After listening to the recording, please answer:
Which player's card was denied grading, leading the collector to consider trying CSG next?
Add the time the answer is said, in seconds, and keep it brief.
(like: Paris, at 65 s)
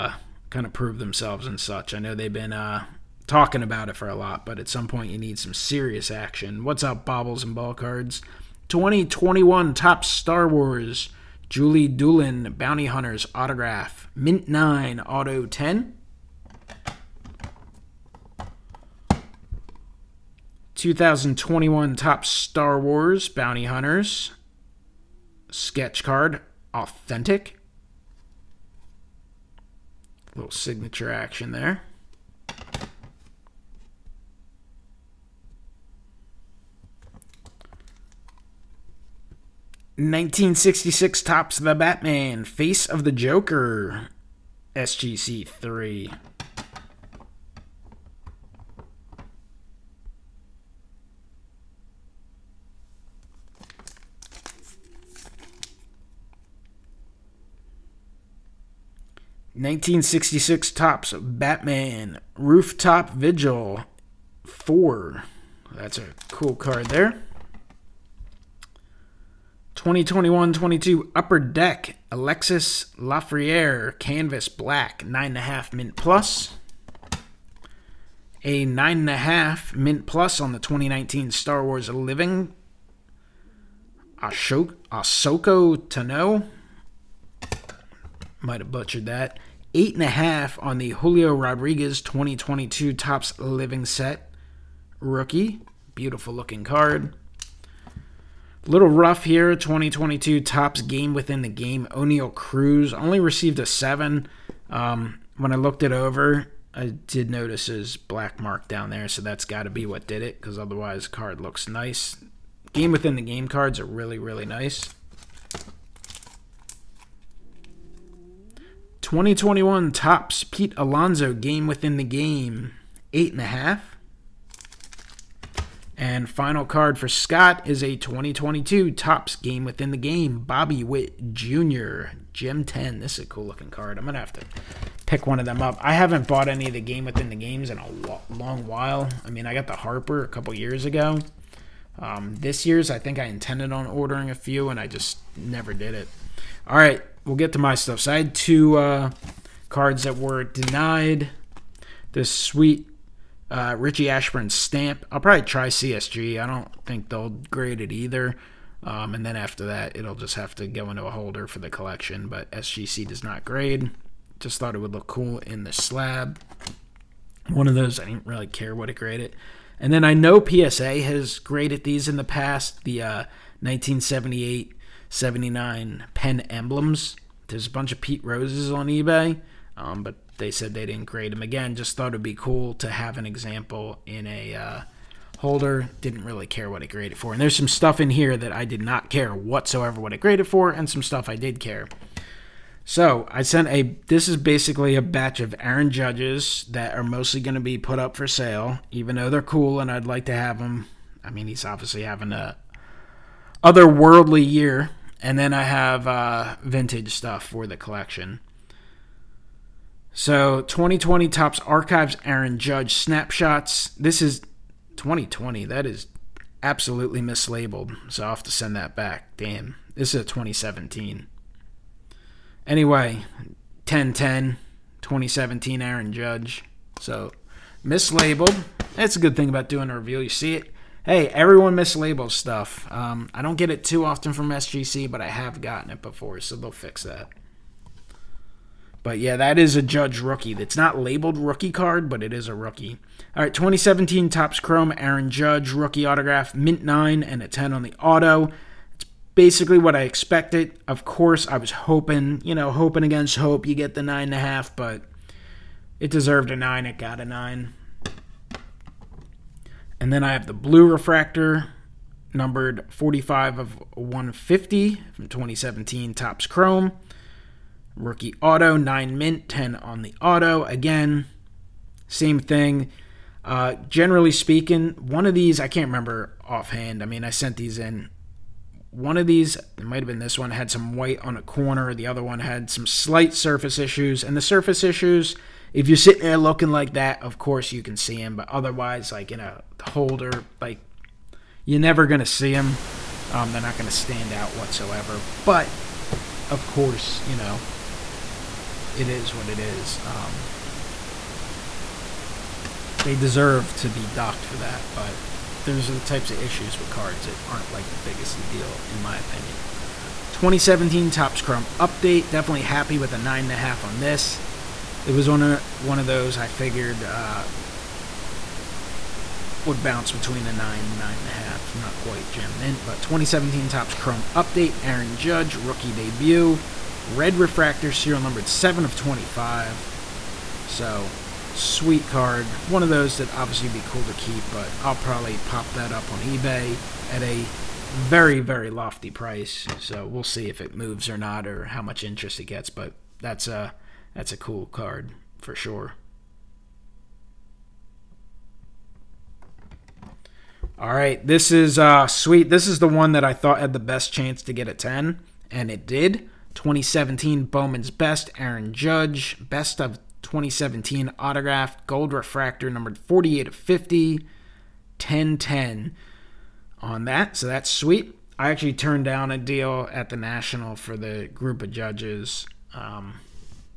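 Richie Ashburn, at 153 s.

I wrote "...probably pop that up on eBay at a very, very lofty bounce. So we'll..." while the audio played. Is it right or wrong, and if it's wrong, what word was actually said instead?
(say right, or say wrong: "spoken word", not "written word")
wrong: "price", not "bounce".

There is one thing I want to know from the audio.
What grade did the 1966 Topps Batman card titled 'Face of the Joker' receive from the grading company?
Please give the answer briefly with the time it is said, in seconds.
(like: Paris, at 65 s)
SGC 3, at 44 s.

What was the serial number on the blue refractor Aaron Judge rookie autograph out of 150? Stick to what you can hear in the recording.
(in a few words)
45.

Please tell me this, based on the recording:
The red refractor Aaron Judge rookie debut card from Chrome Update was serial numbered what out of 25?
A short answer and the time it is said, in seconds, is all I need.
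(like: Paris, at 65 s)
7, at 328 s.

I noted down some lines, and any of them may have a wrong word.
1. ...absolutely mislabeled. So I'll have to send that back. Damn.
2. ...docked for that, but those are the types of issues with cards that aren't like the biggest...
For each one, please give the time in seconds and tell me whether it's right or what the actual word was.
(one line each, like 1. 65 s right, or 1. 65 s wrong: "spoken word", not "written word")
1. 216 s right
2. 304 s right.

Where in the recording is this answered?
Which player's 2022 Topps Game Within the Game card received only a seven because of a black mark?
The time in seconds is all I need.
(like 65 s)
101 s.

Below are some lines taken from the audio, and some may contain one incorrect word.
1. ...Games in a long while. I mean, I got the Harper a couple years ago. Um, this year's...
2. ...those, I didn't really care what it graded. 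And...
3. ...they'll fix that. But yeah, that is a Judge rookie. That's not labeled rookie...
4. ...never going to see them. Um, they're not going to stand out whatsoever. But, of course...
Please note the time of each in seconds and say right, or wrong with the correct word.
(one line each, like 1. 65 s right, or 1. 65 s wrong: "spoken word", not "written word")
1. 137 s right
2. 167 s right
3. 236 s right
4. 291 s right.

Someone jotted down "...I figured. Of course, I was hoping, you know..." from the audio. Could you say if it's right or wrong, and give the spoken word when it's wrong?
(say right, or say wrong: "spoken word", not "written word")
wrong: "expected", not "figured".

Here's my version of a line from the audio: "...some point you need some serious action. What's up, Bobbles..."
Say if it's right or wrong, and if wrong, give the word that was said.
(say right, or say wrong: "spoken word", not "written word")
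right.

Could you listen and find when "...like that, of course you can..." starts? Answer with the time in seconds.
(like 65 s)
286 s.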